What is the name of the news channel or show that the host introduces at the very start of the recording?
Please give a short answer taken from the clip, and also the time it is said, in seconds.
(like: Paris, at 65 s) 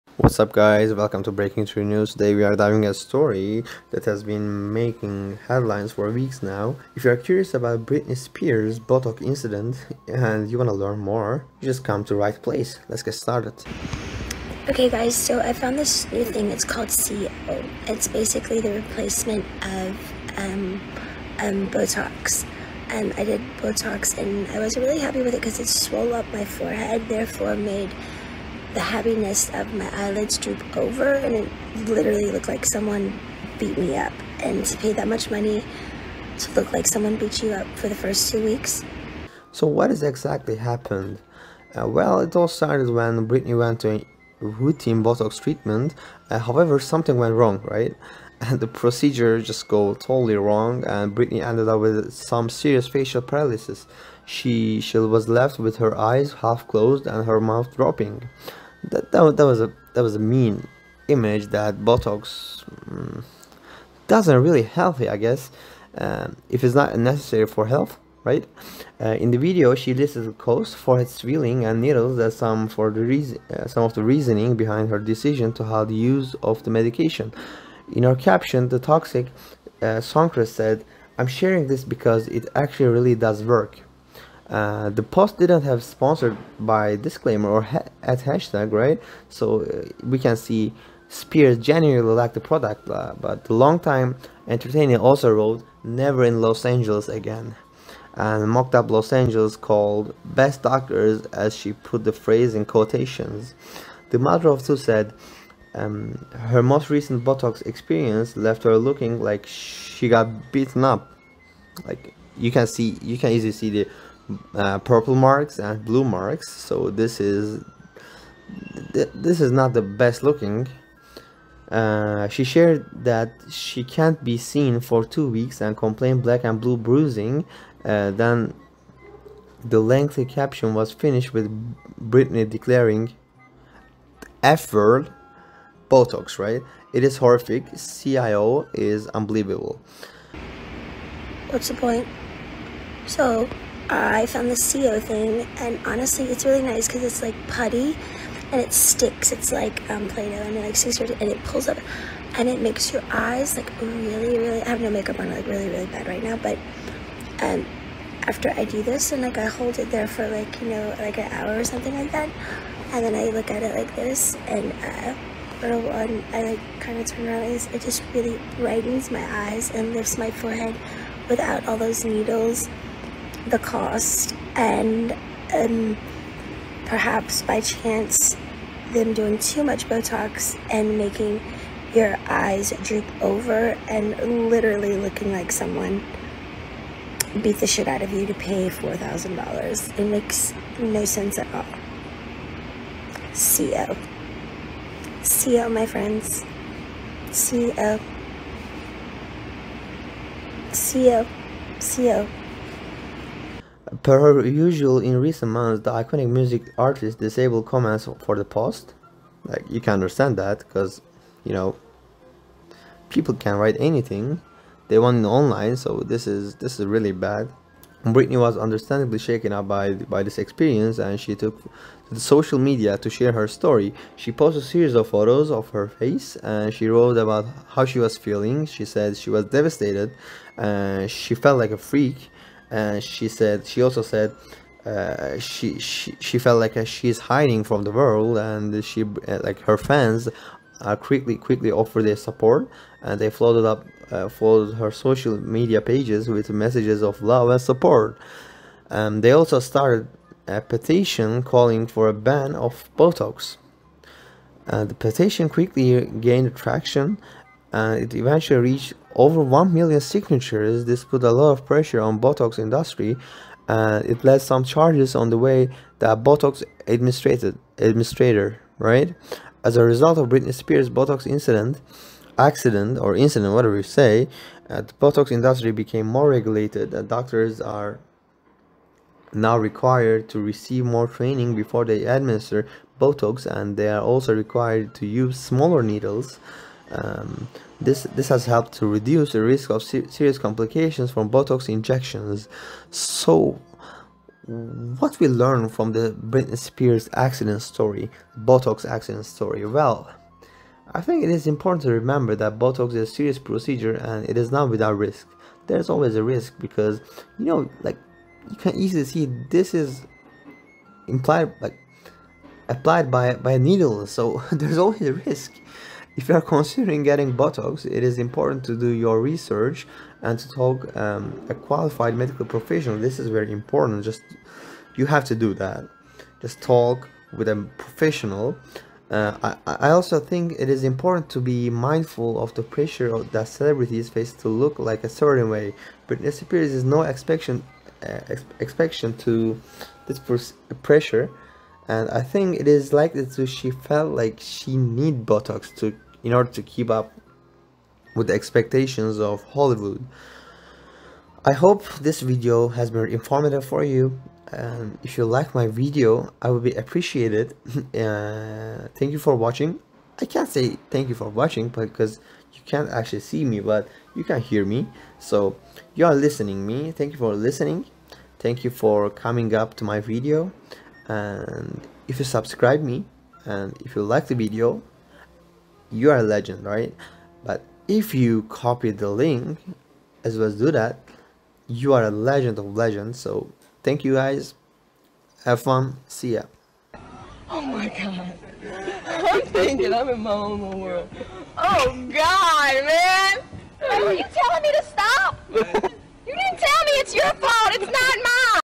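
Breaking True News, at 1 s.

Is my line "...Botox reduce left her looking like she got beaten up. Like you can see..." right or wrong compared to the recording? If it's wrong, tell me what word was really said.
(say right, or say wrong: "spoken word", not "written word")
wrong: "experience", not "reduce".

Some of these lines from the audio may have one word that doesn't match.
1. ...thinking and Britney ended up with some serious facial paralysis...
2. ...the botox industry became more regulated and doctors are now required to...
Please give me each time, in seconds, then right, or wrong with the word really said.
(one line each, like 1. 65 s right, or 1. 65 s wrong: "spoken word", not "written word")
1. 50 s wrong: "wrong", not "thinking"
2. 274 s right.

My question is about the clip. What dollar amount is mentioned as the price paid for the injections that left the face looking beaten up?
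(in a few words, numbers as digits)
$4,000.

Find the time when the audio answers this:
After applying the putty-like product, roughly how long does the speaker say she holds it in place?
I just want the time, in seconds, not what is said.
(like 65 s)
161 s.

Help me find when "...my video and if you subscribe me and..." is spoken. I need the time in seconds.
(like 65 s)
369 s.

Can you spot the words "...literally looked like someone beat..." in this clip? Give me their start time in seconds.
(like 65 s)
31 s.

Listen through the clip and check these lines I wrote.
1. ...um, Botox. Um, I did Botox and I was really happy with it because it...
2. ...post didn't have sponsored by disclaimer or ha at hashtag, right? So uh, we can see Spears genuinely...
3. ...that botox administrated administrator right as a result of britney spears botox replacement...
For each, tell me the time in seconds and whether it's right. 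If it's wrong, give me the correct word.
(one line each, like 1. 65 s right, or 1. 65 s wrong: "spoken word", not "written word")
1. 21 s right
2. 85 s right
3. 265 s wrong: "incident", not "replacement".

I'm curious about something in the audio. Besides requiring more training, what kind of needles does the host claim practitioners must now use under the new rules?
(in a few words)
smaller needles.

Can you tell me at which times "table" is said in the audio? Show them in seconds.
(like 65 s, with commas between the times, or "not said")
not said.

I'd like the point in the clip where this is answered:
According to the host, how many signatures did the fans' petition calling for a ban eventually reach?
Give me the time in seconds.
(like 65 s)
259 s.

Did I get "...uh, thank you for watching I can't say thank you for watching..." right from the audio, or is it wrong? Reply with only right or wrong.
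right.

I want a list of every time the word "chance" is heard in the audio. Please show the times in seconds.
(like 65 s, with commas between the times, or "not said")
177 s.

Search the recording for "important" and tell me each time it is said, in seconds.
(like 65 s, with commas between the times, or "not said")
301 s, 318 s, 323 s, 330 s.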